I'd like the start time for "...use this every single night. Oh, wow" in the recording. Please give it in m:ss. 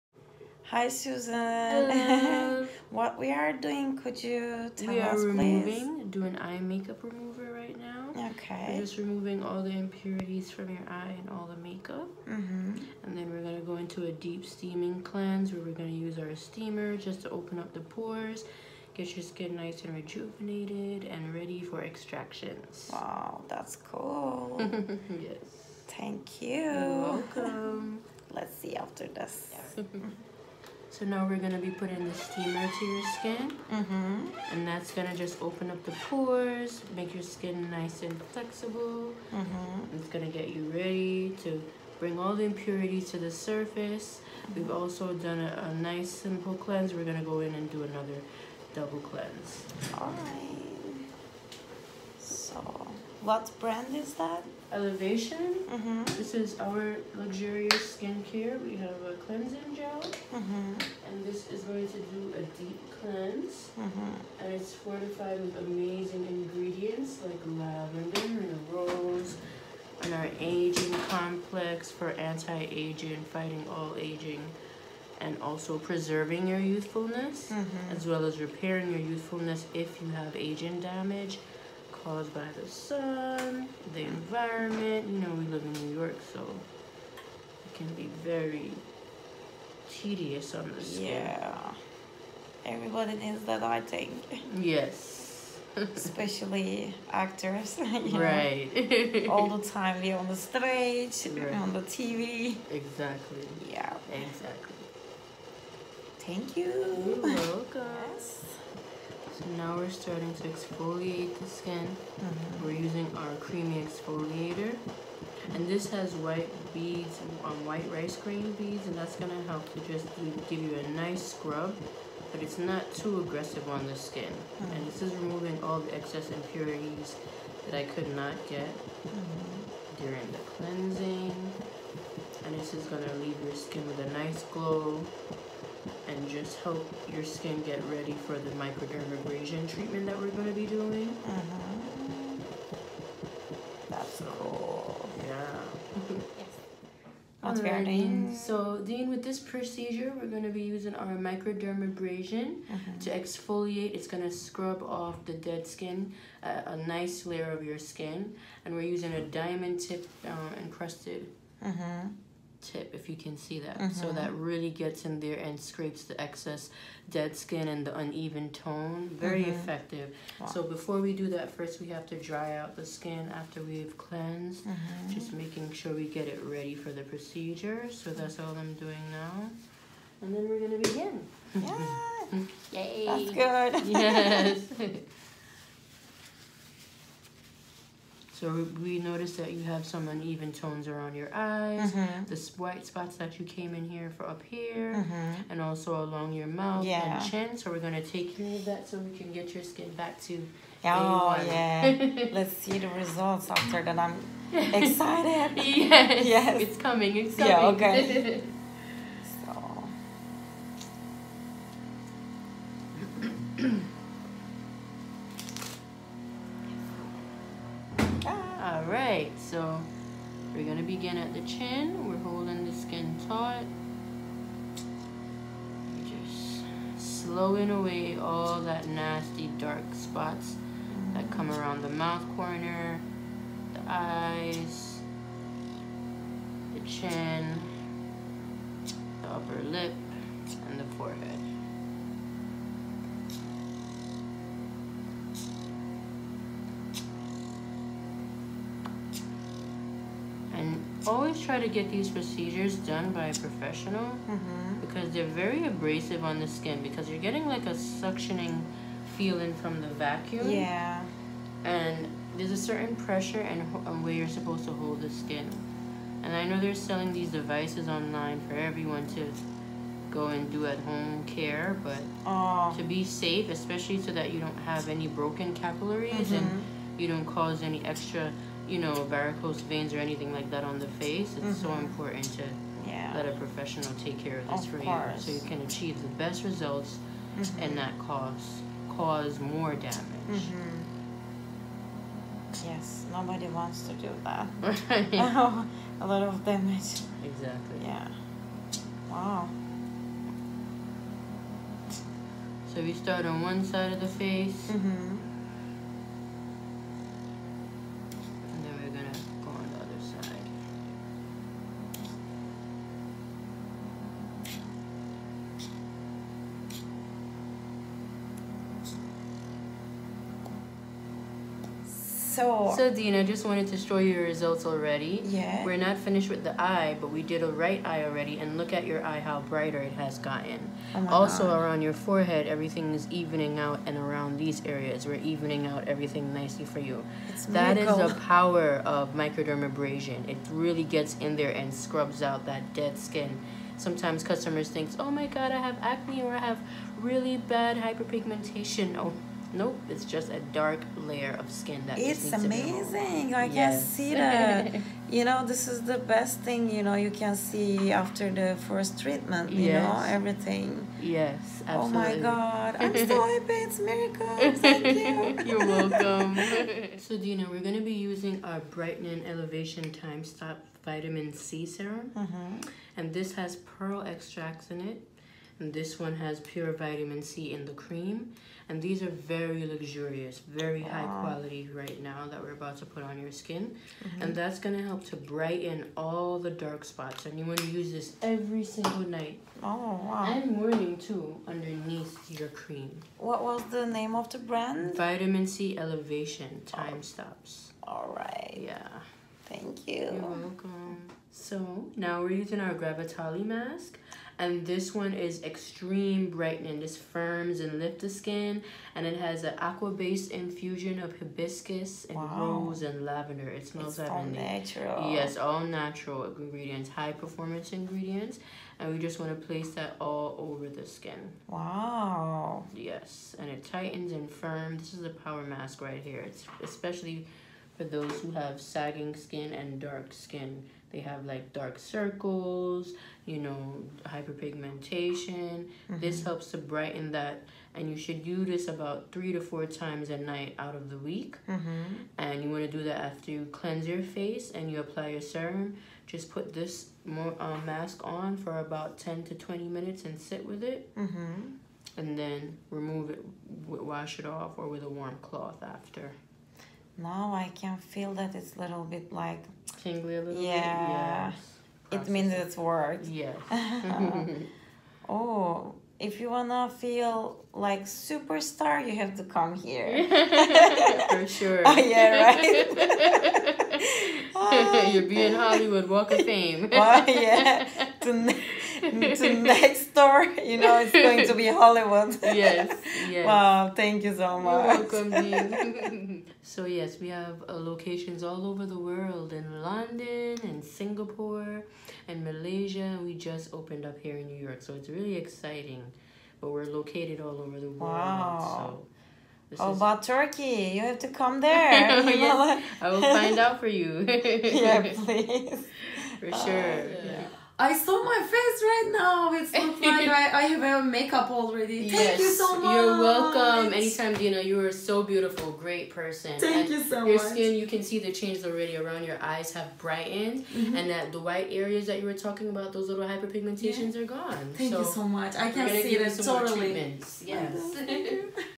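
6:27.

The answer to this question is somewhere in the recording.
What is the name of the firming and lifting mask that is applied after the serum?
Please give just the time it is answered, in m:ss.
6:42.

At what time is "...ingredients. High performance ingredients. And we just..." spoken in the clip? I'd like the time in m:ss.
6:56.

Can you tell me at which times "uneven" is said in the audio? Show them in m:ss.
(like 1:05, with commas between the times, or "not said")
2:47, 3:10.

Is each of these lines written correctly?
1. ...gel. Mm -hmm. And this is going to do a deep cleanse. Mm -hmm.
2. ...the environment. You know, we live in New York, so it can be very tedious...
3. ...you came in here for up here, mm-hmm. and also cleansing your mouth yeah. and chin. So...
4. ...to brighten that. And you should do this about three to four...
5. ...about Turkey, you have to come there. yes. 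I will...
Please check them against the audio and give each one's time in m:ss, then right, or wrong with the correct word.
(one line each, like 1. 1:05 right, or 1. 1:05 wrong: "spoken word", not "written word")
1. 0:59 right
2. 1:23 right
3. 3:13 wrong: "along", not "cleansing"
4. 7:16 right
5. 8:19 right.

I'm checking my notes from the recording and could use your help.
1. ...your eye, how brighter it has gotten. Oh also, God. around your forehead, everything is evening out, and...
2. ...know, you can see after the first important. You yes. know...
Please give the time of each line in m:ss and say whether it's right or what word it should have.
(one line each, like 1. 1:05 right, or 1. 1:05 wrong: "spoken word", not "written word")
1. 5:28 right
2. 5:56 wrong: "treatment", not "important".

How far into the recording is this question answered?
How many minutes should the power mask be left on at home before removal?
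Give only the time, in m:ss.
7:28.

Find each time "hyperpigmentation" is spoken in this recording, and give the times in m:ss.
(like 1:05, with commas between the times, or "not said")
5:47, 7:14, 8:43.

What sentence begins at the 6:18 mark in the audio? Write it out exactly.
And these are very luxurious, very high quality right now that we're about to put on your skin.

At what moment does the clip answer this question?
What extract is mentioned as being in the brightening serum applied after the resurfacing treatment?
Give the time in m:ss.
6:13.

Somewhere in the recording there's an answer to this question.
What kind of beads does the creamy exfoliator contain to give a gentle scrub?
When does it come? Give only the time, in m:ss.
1:57.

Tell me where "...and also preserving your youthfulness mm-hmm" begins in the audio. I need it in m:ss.
1:15.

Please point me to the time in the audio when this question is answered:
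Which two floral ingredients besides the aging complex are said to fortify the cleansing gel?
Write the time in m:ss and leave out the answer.
1:07.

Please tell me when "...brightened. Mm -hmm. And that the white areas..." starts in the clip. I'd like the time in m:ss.
8:39.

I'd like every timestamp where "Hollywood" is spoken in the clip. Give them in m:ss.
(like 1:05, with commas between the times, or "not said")
7:55, 8:01.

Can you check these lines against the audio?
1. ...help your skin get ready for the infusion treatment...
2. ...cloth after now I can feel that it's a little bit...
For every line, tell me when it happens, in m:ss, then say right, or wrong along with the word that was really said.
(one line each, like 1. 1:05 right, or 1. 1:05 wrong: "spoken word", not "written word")
1. 2:16 wrong: "microdermabrasion", not "infusion"
2. 7:35 right.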